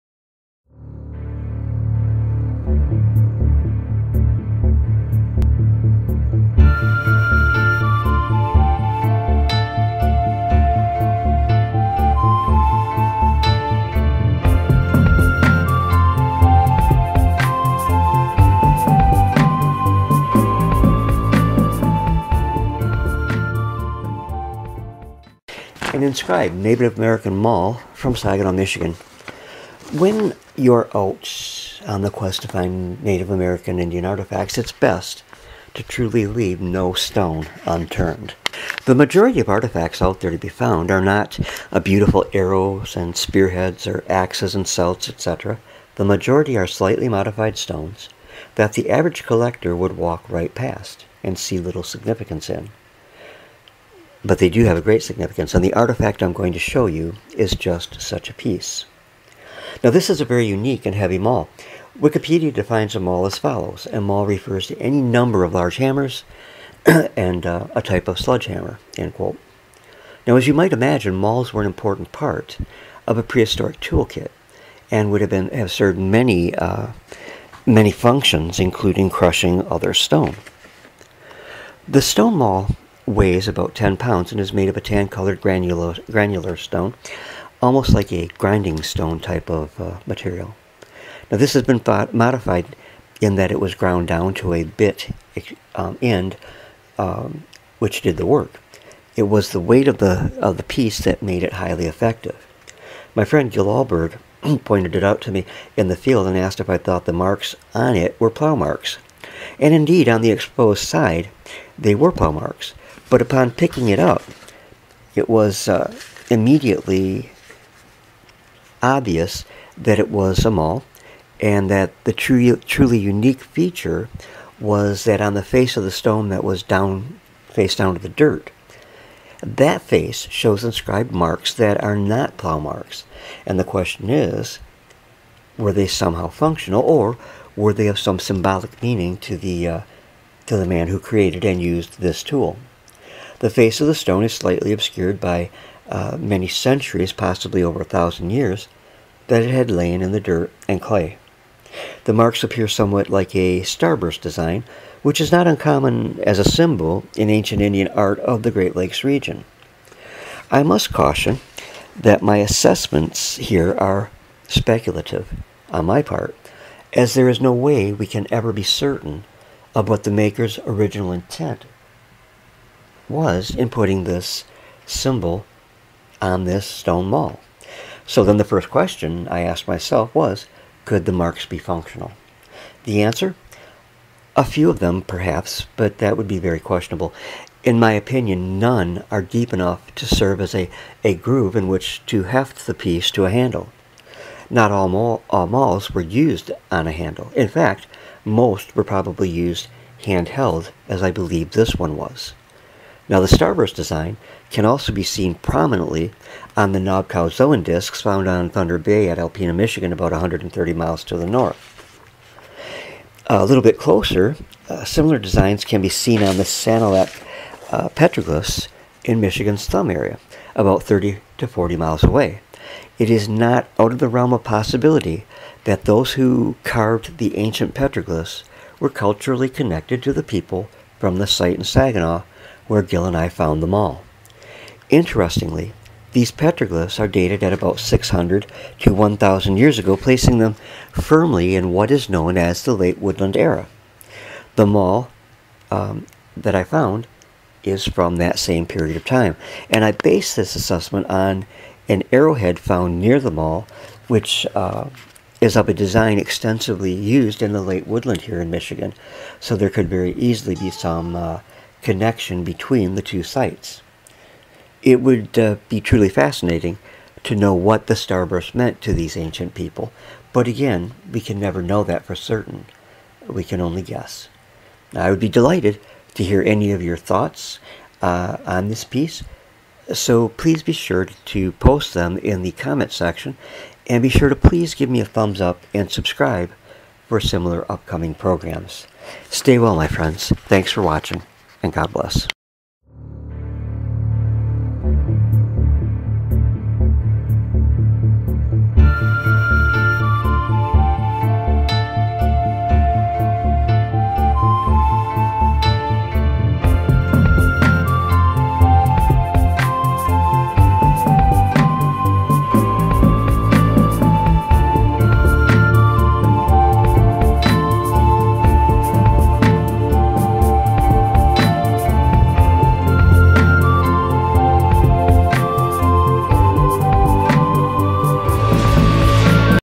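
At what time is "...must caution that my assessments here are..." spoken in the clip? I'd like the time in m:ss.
2:40.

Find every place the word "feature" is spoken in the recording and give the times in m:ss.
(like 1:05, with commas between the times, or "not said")
2:03.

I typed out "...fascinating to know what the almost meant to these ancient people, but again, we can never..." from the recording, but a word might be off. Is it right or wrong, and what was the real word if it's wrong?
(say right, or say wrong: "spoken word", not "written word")
wrong: "starburst", not "almost".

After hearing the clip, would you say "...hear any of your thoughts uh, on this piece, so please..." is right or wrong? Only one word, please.
right.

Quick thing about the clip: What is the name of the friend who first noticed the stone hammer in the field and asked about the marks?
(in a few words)
Gil Alberg.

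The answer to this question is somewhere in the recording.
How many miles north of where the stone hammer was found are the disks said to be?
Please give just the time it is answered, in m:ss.
3:30.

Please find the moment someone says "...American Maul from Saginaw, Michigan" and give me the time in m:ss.
0:26.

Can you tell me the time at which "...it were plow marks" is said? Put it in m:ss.
1:47.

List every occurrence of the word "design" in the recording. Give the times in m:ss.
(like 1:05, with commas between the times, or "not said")
2:34, 3:23, 3:35, 4:15.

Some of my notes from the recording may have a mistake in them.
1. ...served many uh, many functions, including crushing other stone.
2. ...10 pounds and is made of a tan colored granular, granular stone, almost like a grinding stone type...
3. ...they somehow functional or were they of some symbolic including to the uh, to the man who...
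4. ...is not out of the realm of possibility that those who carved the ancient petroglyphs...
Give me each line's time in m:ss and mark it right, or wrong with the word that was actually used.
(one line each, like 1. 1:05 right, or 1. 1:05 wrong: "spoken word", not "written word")
1. 1:15 right
2. 1:23 right
3. 2:15 wrong: "meaning", not "including"
4. 3:43 right.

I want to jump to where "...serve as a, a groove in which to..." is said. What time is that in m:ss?
3:10.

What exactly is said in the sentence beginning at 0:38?
The majority of artifacts out there to be found are not beautiful arrows and spearheads or axes and celts, etc.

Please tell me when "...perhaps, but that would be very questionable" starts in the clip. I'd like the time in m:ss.
3:05.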